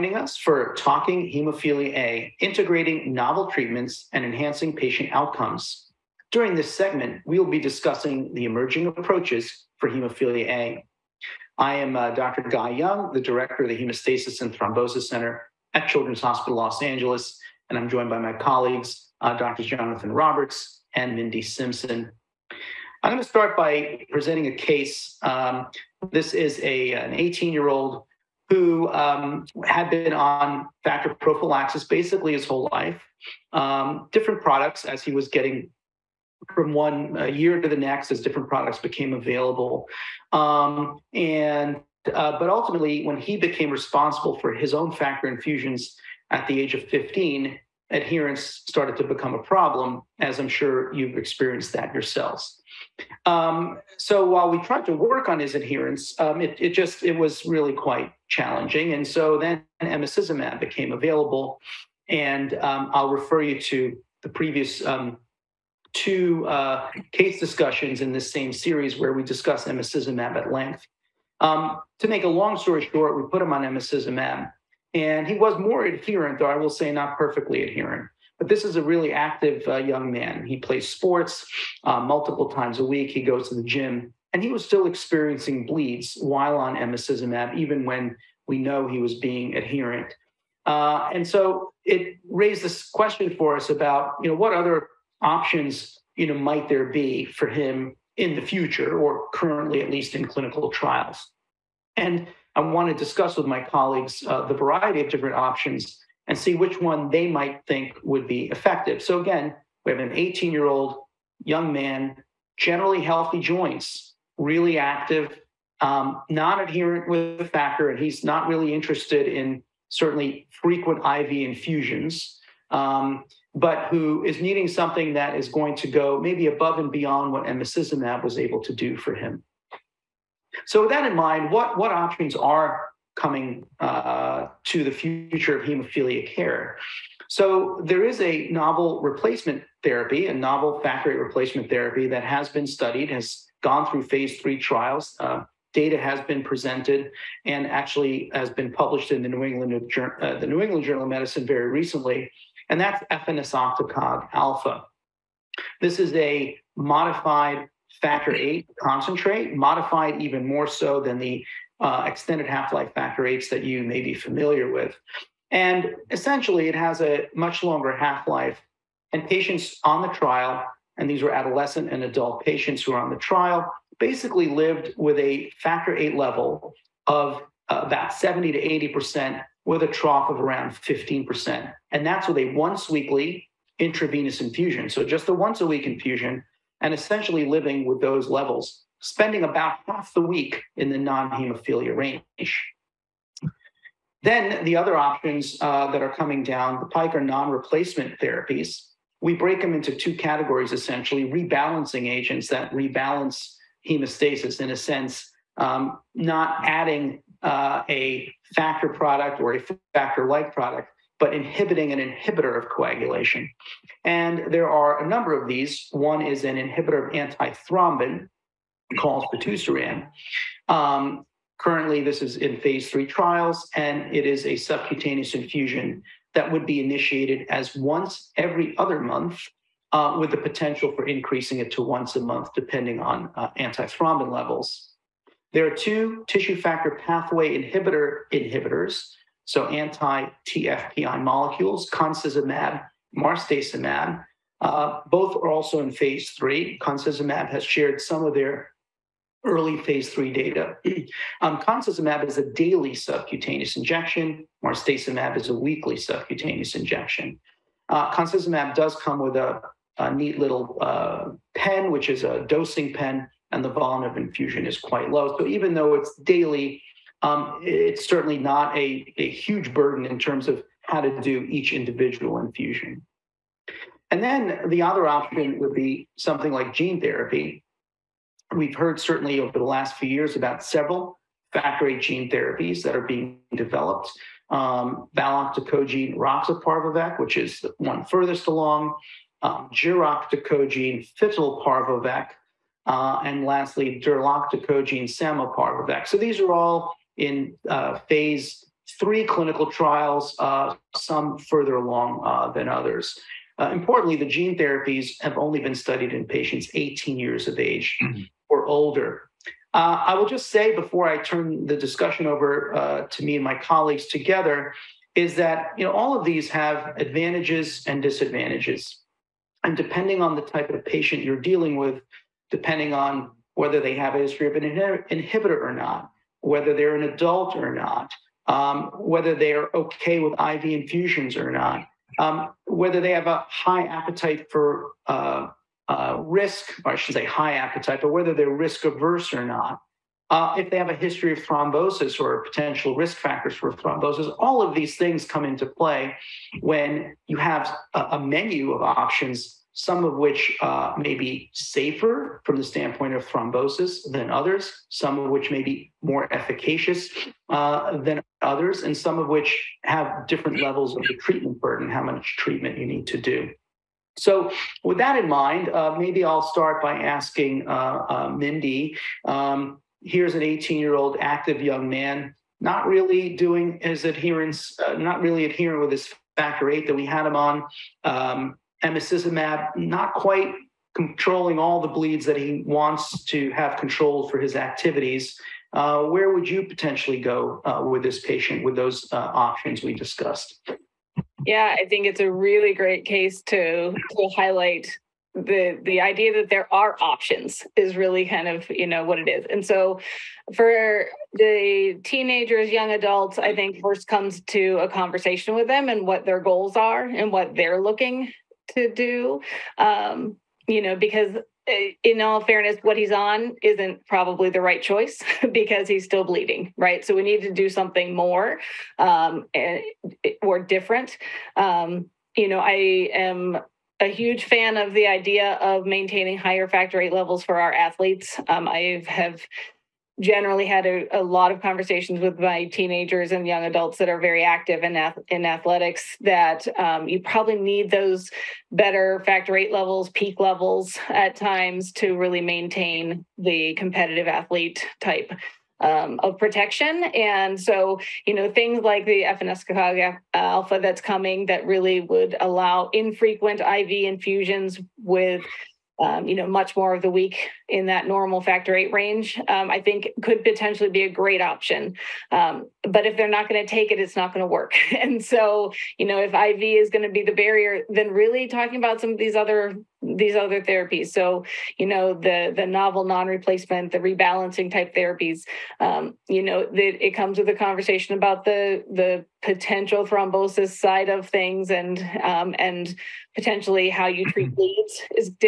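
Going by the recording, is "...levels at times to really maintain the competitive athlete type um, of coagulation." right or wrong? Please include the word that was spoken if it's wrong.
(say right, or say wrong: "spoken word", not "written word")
wrong: "protection", not "coagulation".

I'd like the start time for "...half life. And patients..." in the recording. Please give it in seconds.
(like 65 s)
167 s.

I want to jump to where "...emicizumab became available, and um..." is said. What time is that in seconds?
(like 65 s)
59 s.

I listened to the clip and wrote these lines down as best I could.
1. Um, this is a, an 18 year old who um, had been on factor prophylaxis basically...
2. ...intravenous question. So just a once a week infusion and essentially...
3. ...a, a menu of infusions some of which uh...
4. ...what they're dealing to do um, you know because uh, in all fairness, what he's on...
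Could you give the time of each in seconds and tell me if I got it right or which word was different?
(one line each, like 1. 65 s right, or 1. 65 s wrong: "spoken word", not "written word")
1. 25 s right
2. 183 s wrong: "infusion", not "question"
3. 347 s wrong: "options", not "infusions"
4. 407 s wrong: "looking", not "dealing".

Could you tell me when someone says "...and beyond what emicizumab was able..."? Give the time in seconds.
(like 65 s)
126 s.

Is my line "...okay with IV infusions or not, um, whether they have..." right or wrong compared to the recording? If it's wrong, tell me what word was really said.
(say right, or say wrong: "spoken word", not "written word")
right.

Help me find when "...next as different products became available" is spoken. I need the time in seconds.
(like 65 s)
37 s.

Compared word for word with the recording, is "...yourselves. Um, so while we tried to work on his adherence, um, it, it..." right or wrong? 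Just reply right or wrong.
right.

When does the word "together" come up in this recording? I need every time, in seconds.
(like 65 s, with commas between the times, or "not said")
314 s.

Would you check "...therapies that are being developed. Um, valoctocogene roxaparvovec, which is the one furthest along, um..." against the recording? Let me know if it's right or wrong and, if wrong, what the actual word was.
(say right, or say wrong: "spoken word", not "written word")
right.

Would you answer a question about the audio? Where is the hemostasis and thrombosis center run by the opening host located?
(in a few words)
Children's Hospital Los Angeles.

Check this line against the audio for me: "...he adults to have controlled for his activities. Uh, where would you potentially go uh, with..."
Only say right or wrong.
wrong.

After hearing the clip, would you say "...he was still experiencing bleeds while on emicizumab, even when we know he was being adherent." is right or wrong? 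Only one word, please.
right.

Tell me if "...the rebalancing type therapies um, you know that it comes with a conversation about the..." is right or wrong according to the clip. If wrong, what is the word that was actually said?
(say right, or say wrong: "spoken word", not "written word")
right.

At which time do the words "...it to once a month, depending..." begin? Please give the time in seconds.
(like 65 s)
231 s.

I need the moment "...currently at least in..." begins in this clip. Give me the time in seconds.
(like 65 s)
99 s.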